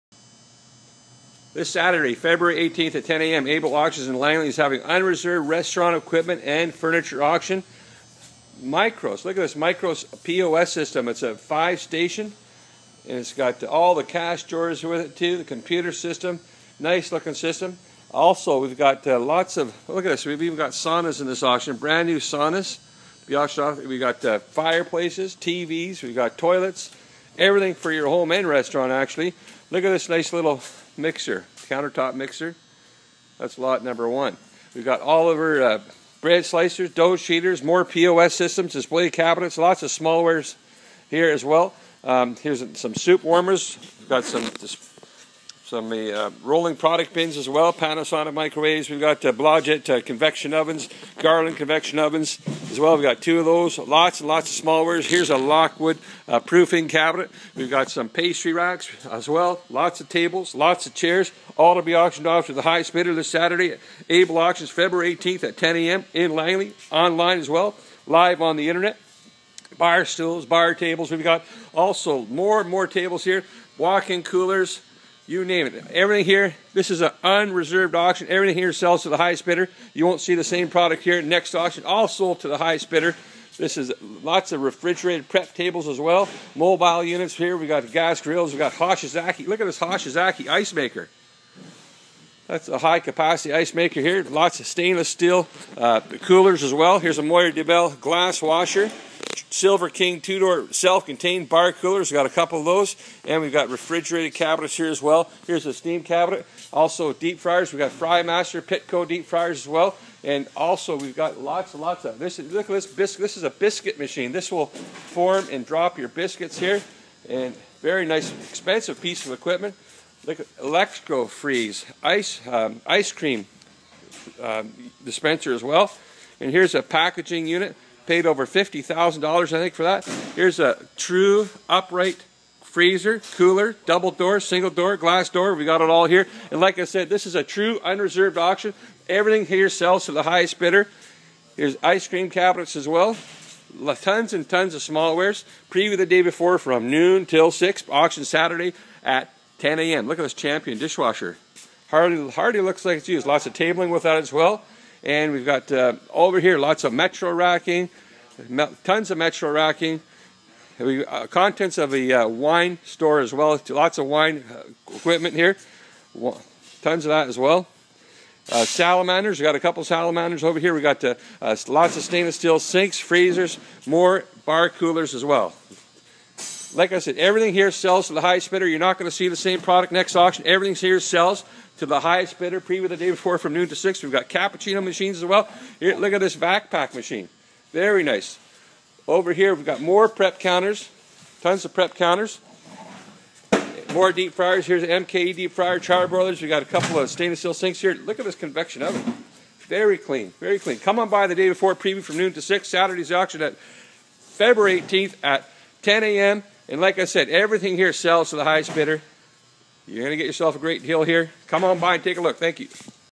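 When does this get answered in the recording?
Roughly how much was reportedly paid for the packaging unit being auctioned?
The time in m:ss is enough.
2:08.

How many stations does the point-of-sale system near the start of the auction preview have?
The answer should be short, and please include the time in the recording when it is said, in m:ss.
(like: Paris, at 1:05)
5, at 0:11.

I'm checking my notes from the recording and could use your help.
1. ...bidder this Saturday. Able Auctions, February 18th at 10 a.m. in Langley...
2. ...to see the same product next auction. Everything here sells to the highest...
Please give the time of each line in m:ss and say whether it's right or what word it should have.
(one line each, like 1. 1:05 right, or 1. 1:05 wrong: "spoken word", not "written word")
1. 1:02 right
2. 2:59 right.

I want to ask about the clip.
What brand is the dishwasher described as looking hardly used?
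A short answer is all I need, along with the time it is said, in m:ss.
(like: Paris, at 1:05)
Champion, at 2:30.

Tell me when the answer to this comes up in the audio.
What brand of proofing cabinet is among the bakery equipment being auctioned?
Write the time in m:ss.
0:55.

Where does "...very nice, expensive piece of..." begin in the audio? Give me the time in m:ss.
1:57.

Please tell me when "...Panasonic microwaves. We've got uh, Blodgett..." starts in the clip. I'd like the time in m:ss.
0:47.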